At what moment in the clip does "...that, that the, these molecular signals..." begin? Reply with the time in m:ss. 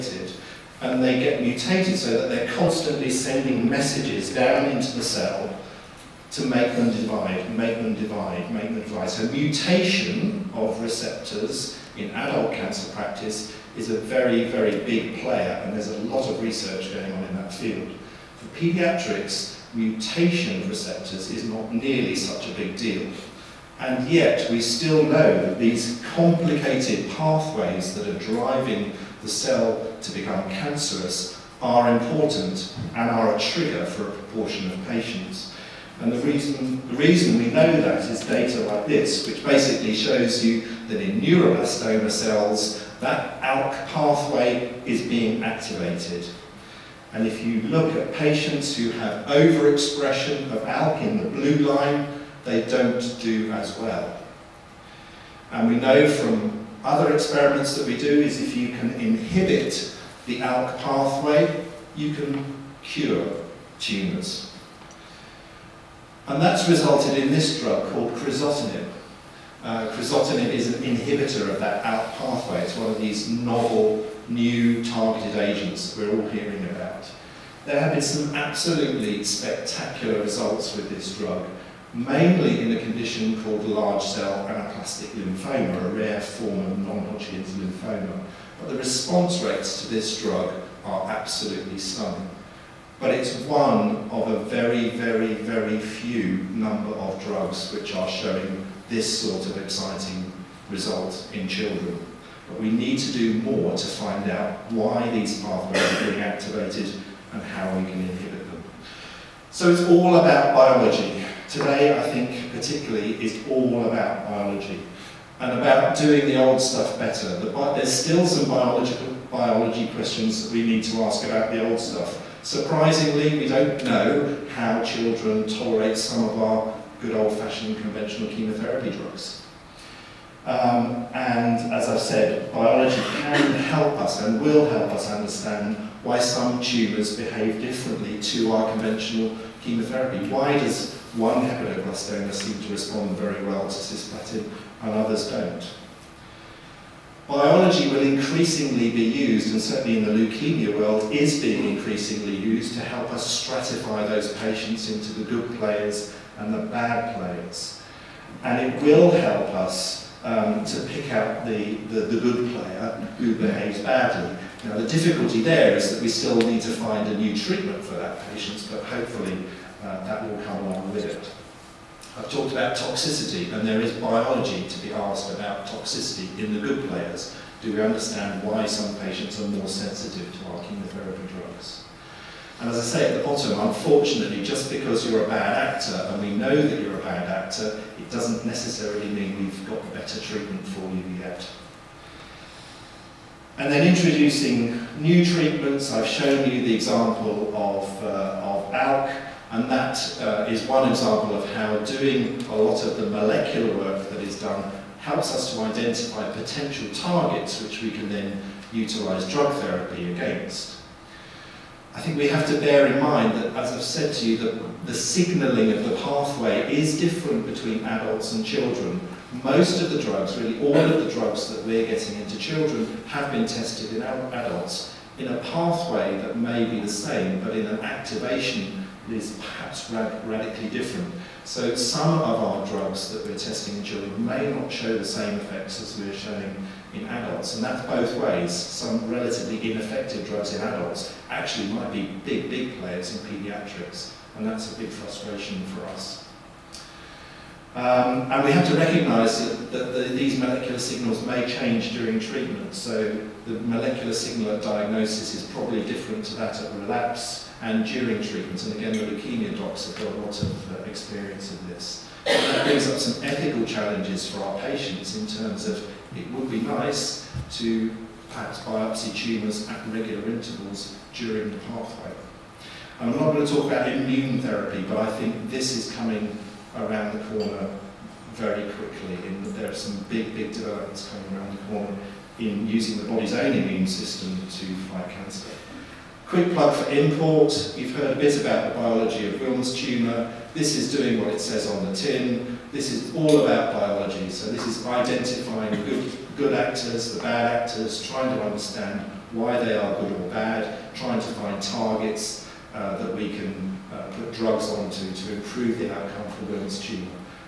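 4:09.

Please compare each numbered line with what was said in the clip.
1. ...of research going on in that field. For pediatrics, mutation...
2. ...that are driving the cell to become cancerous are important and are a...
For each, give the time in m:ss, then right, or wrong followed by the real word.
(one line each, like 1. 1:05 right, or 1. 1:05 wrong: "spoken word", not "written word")
1. 0:16 right
2. 0:27 right.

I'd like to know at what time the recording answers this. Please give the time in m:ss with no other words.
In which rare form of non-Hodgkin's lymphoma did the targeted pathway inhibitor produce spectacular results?
1:23.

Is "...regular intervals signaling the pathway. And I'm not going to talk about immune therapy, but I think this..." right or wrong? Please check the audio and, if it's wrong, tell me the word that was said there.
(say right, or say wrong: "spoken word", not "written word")
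wrong: "during", not "signaling".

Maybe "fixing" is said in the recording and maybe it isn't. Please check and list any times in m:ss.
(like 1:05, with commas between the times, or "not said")
not said.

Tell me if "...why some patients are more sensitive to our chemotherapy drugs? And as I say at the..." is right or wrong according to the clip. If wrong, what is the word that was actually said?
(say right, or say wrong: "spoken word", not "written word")
right.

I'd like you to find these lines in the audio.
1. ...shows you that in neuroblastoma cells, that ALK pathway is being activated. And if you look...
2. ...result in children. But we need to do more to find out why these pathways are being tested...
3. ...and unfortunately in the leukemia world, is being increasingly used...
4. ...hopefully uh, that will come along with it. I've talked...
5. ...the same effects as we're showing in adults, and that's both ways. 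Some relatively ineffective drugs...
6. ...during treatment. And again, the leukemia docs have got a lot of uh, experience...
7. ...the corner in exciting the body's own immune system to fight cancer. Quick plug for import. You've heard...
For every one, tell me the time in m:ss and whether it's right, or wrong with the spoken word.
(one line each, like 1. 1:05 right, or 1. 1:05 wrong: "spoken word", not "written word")
1. 0:39 right
2. 1:40 wrong: "activated", not "tested"
3. 2:29 wrong: "certainly", not "unfortunately"
4. 2:48 right
5. 3:54 right
6. 4:17 right
7. 4:41 wrong: "using", not "exciting".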